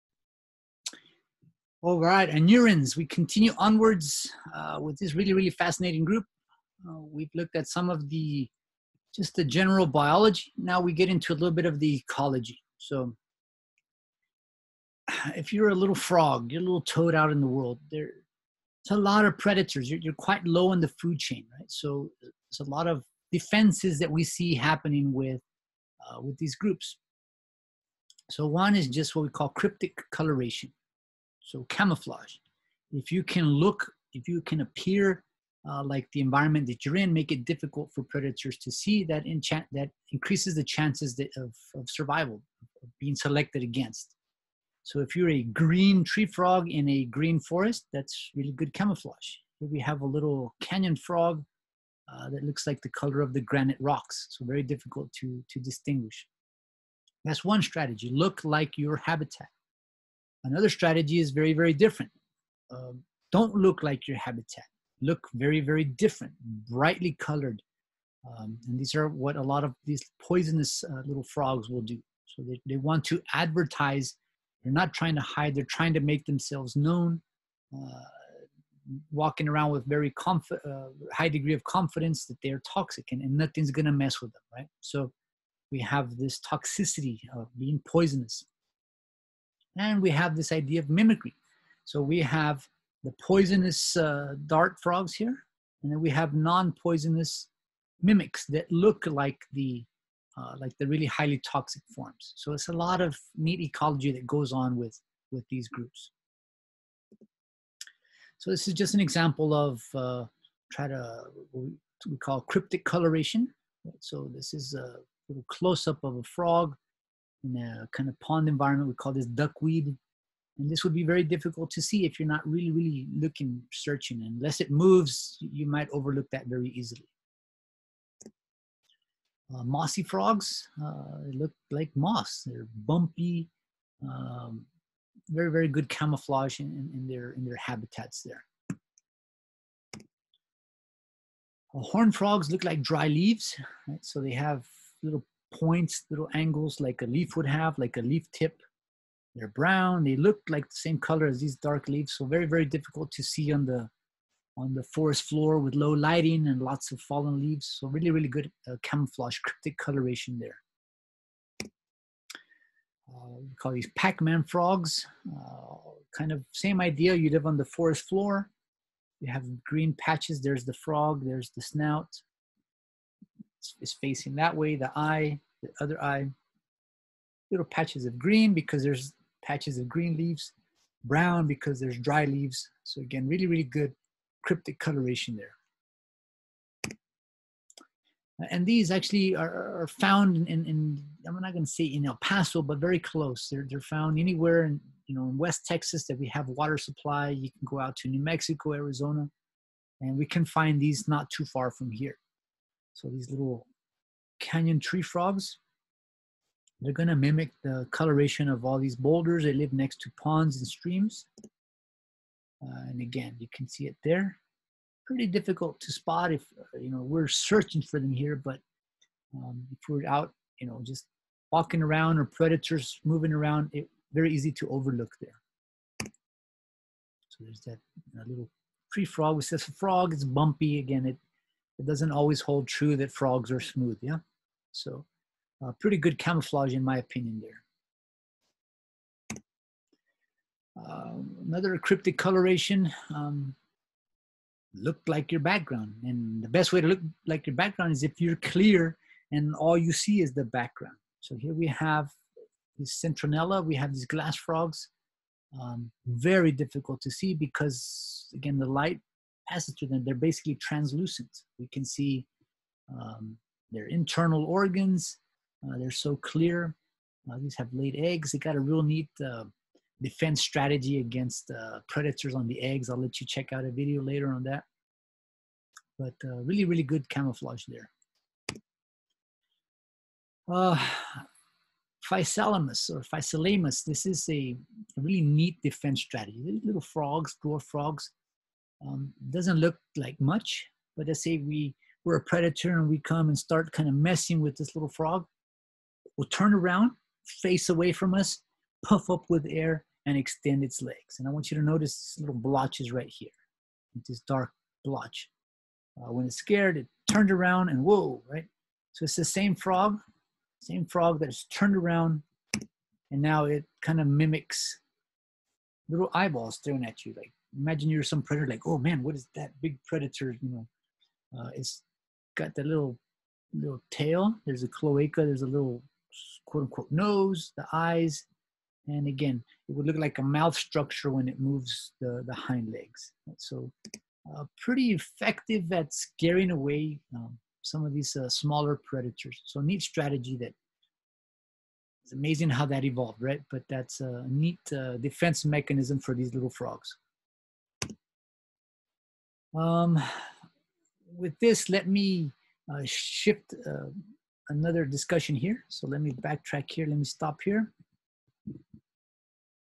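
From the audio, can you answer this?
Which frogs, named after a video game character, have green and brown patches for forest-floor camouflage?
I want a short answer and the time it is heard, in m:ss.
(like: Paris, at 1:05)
Pac-Man frogs, at 2:43.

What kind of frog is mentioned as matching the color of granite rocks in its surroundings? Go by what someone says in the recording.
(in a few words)
canyon frog.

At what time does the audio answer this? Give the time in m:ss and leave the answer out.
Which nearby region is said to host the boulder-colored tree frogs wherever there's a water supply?
3:15.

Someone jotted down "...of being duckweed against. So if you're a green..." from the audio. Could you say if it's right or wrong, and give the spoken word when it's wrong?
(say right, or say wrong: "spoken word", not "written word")
wrong: "selected", not "duckweed".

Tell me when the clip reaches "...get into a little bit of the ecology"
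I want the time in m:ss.
0:10.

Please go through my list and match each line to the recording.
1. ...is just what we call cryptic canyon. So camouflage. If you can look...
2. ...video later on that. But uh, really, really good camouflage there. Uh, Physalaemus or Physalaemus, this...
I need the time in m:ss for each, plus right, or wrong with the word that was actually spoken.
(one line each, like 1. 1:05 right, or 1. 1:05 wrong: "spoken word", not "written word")
1. 0:28 wrong: "coloration", not "canyon"
2. 4:33 right.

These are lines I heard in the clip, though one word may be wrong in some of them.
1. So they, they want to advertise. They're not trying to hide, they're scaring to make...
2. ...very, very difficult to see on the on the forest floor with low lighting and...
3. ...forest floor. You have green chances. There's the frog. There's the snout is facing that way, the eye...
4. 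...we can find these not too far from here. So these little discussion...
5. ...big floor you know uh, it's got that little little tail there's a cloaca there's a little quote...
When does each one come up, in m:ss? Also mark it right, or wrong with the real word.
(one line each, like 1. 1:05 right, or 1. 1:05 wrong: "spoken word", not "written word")
1. 1:12 wrong: "trying", not "scaring"
2. 2:32 right
3. 2:47 wrong: "patches", not "chances"
4. 3:20 wrong: "canyon", not "discussion"
5. 5:19 wrong: "predator", not "floor".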